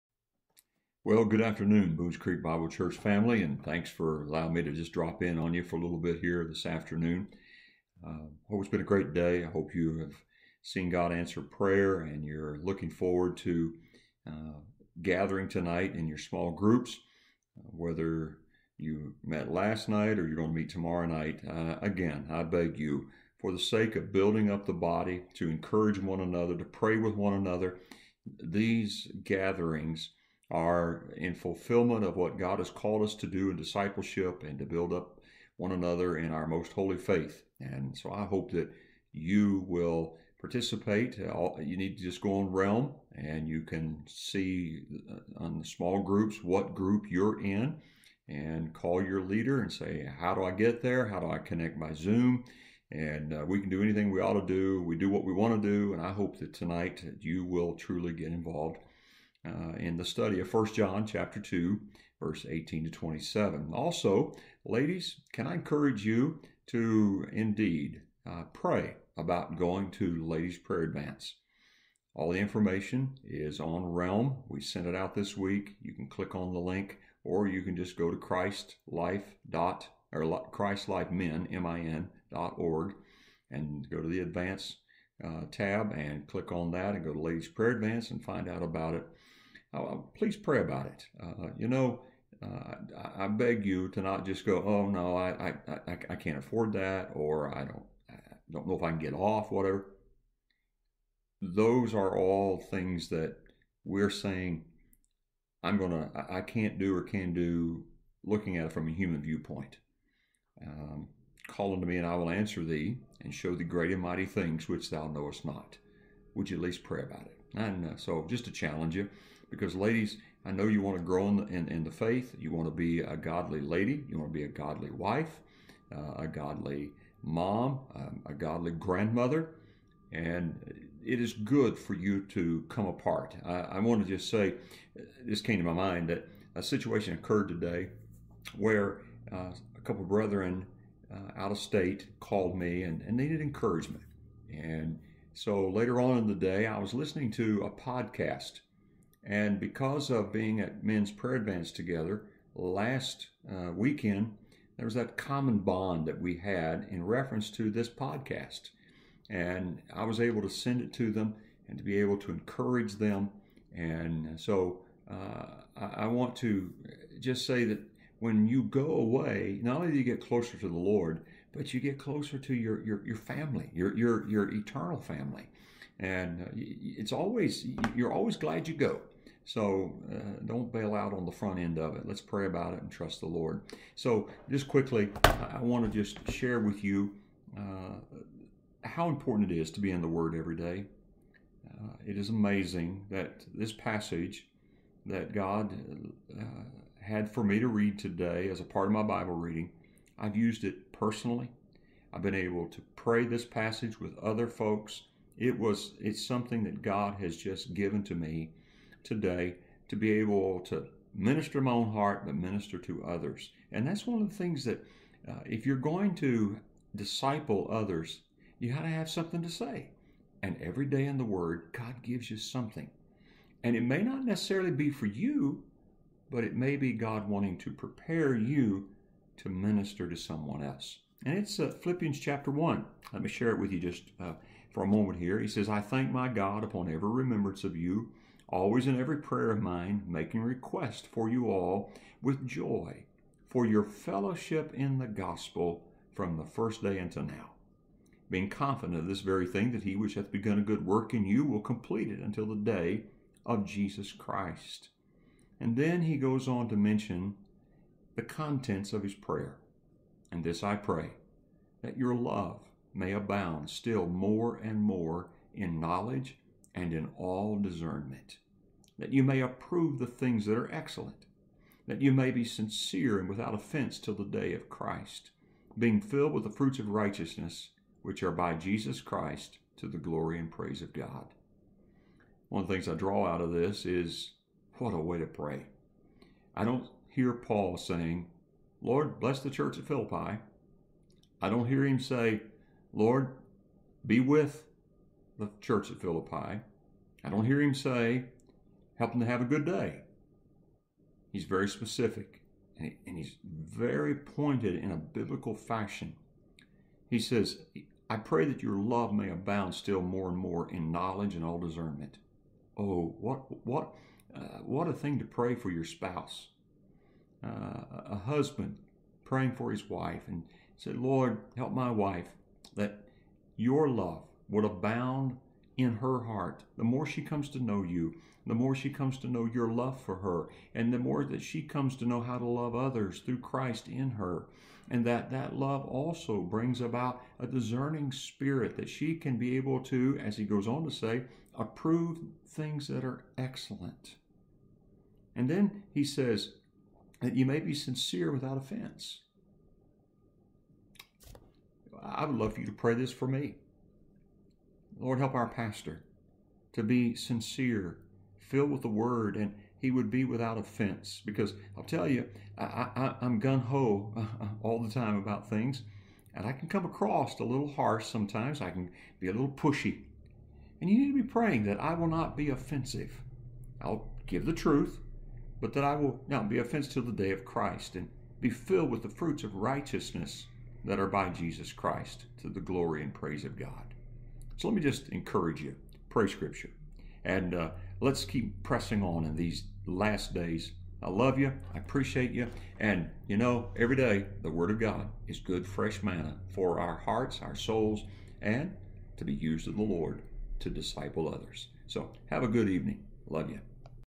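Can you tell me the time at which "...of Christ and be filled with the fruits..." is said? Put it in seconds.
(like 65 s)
377 s.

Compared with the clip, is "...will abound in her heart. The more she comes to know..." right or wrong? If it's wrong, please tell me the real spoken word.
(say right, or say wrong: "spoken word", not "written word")
right.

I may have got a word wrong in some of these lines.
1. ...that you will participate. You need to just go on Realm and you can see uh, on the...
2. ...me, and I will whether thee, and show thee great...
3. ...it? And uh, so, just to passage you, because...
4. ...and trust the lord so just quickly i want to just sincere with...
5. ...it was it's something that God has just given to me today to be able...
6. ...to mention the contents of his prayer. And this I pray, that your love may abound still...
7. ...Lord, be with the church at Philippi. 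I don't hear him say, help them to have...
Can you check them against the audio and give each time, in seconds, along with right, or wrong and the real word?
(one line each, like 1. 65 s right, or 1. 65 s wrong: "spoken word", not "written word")
1. 38 s right
2. 111 s wrong: "answer", not "whether"
3. 117 s wrong: "challenge", not "passage"
4. 182 s wrong: "share", not "sincere"
5. 205 s right
6. 256 s right
7. 292 s right.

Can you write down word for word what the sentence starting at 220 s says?
And every day in the Word, God gives you something.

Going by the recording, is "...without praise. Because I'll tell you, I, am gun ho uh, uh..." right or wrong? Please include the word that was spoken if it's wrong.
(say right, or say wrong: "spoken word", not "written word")
wrong: "offense", not "praise".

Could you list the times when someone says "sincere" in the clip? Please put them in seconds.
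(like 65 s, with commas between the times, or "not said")
272 s, 347 s, 357 s.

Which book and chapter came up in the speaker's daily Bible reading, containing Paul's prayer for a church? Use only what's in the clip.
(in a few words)
Philippians 1.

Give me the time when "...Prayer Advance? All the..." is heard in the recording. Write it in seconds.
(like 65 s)
70 s.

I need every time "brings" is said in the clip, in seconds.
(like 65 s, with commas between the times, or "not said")
336 s.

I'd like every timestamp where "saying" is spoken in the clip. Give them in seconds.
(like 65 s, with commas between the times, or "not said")
104 s, 287 s.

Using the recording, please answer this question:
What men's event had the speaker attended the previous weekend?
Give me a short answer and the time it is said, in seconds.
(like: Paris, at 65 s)
Men's Prayer Advance, at 150 s.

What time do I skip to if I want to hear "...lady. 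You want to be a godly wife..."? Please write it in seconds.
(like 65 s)
123 s.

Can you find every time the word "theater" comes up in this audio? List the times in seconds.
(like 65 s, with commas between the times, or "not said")
not said.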